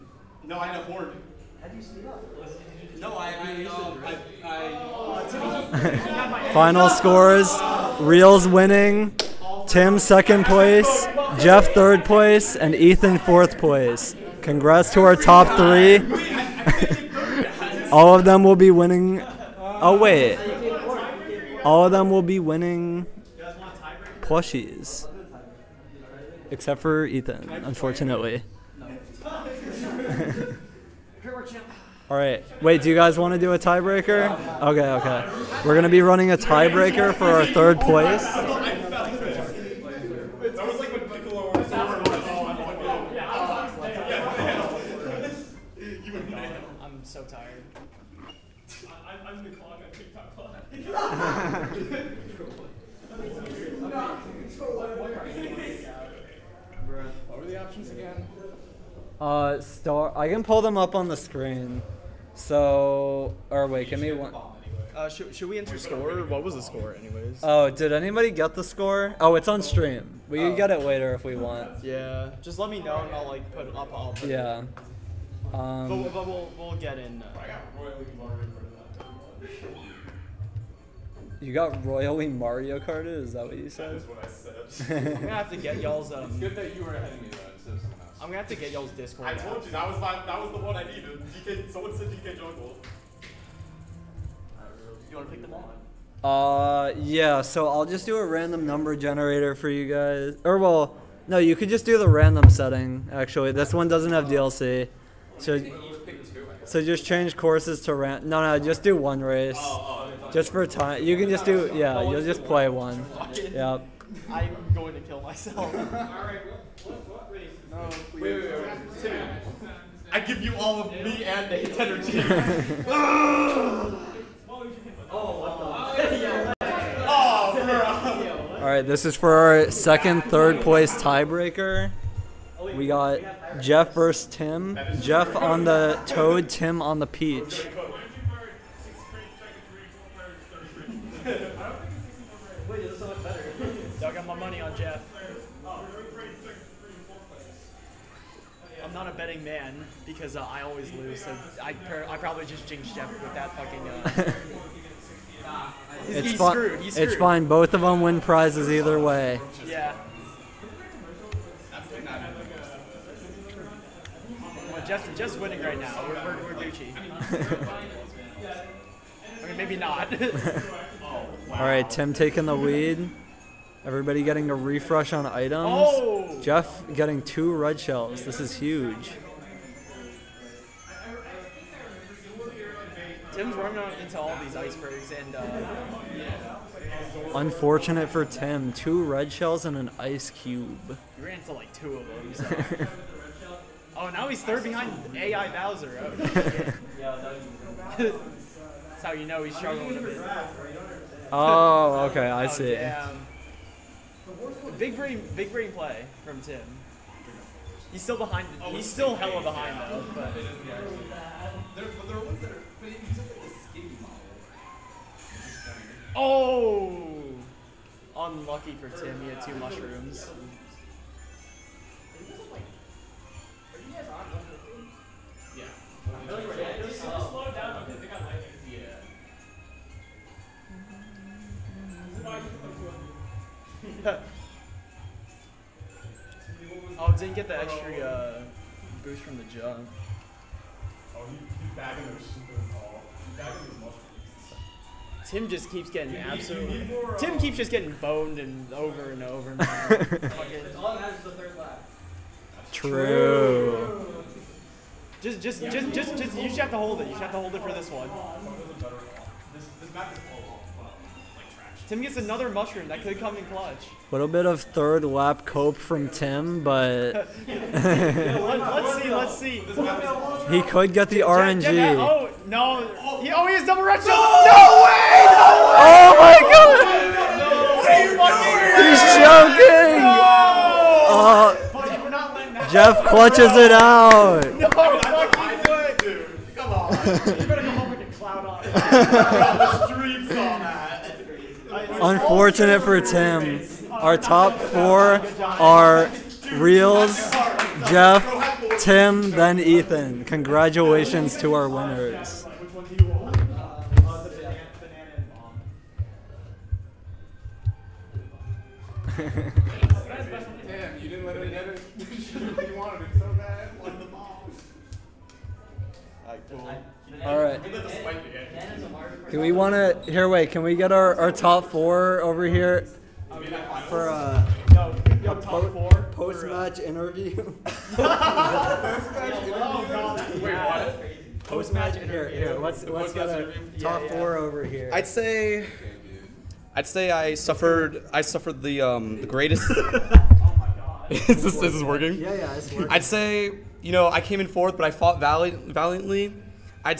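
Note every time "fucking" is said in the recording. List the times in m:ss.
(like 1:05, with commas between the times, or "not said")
2:33, 4:44.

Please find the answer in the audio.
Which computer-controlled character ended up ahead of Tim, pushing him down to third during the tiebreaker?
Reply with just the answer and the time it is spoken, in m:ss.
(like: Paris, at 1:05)
Bowser, at 3:15.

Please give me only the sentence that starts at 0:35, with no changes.
We're going to be running a tiebreaker for our third place.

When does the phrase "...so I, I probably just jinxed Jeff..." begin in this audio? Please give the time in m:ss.
2:31.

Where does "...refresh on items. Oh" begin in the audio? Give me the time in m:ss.
2:54.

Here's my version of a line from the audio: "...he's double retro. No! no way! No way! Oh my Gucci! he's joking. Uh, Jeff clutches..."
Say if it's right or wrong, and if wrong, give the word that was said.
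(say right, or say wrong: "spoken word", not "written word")
wrong: "God", not "Gucci".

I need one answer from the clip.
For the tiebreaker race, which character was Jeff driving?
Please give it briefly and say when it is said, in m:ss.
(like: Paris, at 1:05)
Toad, at 2:15.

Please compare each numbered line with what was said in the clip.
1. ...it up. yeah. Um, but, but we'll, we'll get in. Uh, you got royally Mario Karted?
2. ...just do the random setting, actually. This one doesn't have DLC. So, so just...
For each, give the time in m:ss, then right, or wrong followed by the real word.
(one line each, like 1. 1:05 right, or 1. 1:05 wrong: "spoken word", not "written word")
1. 1:13 right
2. 1:41 right.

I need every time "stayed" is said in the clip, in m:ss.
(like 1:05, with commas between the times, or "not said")
not said.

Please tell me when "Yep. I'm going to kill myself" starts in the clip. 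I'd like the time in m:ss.
1:53.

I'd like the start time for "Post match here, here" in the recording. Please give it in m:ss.
5:31.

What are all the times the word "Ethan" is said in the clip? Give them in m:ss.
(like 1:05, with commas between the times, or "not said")
0:12, 0:27.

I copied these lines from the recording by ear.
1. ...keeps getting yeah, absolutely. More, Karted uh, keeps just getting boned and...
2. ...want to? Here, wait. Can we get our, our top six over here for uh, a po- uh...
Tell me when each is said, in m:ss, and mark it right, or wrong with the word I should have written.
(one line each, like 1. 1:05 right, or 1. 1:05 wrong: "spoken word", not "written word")
1. 4:05 wrong: "Tim", not "Karted"
2. 5:19 wrong: "four", not "six".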